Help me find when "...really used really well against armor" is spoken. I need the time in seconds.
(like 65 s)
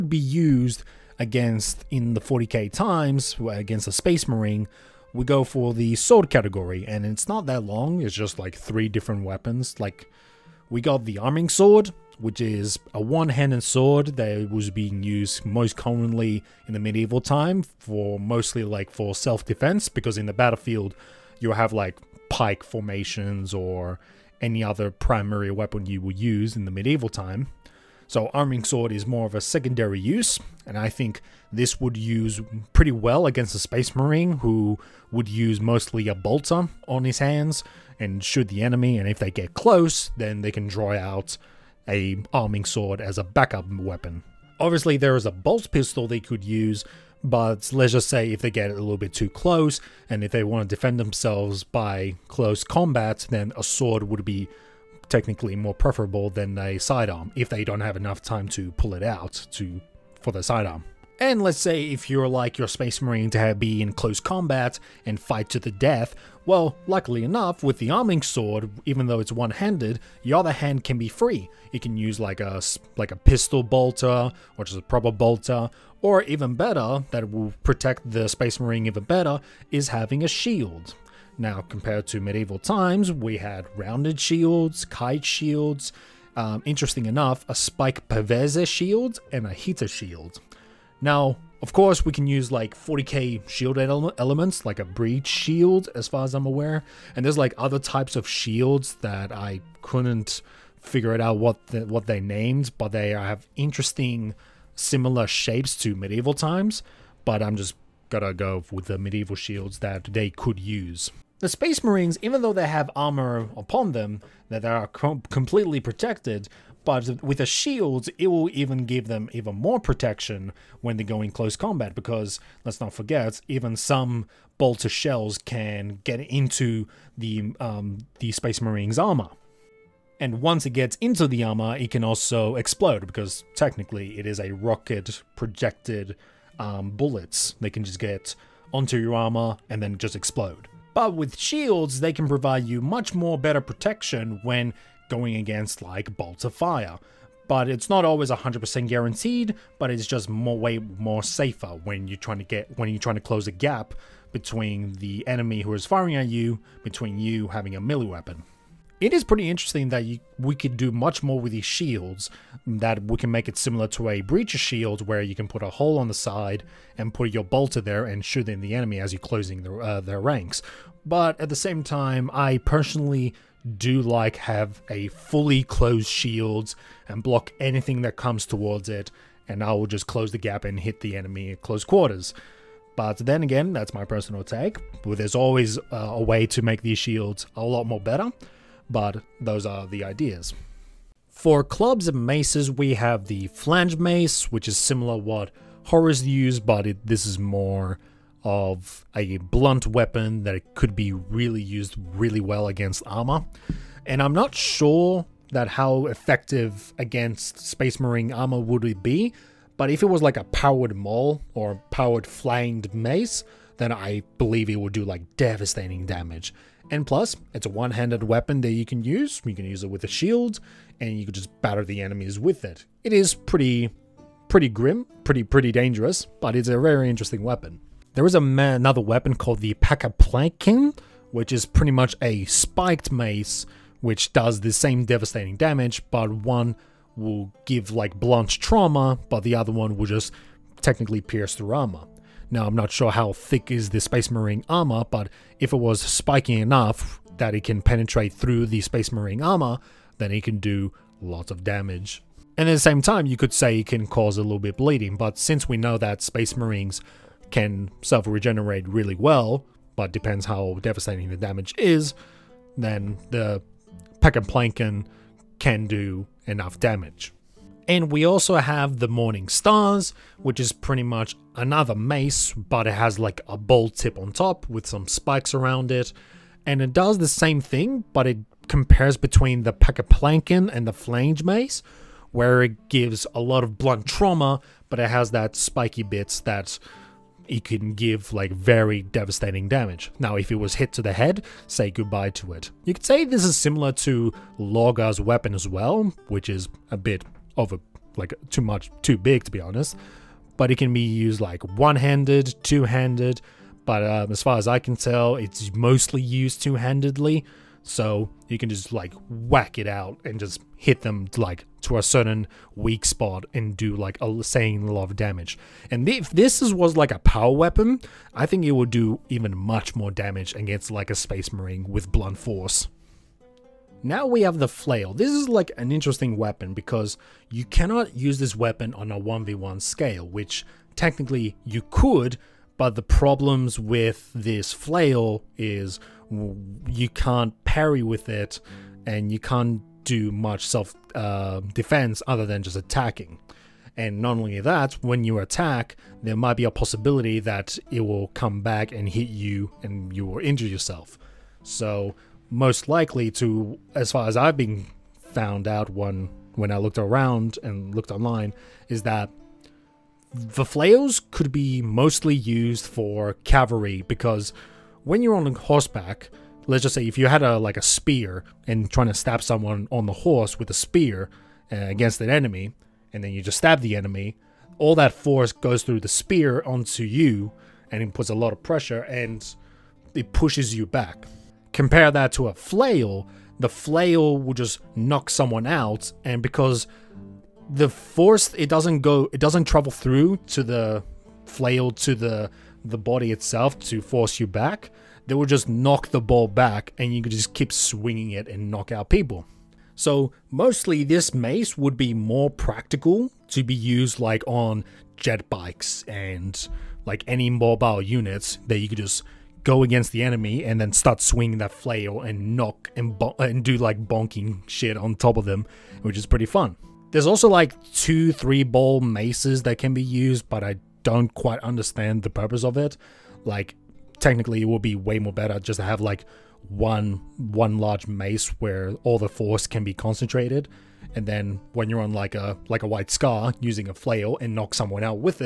201 s.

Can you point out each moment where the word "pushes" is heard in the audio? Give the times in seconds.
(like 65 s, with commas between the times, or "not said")
380 s.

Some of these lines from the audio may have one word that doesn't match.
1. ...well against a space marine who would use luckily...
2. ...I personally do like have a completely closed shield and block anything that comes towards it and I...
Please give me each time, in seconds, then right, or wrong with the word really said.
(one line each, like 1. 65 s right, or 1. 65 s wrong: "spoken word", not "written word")
1. 32 s wrong: "mostly", not "luckily"
2. 172 s wrong: "fully", not "completely".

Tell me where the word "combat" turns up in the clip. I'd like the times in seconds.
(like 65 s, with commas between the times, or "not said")
52 s, 64 s, 121 s.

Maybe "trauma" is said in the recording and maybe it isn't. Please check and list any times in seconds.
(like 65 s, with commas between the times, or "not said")
238 s, 284 s.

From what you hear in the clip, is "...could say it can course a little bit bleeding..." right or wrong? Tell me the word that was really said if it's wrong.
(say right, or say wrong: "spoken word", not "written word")
wrong: "cause", not "course".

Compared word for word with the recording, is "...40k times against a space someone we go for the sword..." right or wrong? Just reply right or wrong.
wrong.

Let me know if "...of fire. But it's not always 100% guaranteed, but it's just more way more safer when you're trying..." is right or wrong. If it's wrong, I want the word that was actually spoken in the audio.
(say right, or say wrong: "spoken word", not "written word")
right.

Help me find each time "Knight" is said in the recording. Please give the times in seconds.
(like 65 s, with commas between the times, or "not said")
not said.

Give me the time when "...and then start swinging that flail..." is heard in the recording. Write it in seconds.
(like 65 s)
410 s.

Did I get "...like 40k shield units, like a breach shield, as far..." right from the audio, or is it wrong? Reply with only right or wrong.
wrong.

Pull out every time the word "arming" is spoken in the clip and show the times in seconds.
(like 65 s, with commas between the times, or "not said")
11 s, 28 s, 42 s, 67 s.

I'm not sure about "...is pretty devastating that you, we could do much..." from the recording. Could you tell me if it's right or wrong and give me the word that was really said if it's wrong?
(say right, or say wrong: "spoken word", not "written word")
wrong: "interesting", not "devastating".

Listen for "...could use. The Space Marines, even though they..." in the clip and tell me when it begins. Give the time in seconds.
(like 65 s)
110 s.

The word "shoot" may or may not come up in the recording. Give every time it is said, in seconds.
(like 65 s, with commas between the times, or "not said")
38 s, 168 s.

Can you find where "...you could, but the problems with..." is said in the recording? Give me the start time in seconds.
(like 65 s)
331 s.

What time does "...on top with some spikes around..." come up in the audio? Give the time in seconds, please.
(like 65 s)
274 s.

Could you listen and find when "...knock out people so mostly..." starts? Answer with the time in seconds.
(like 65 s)
398 s.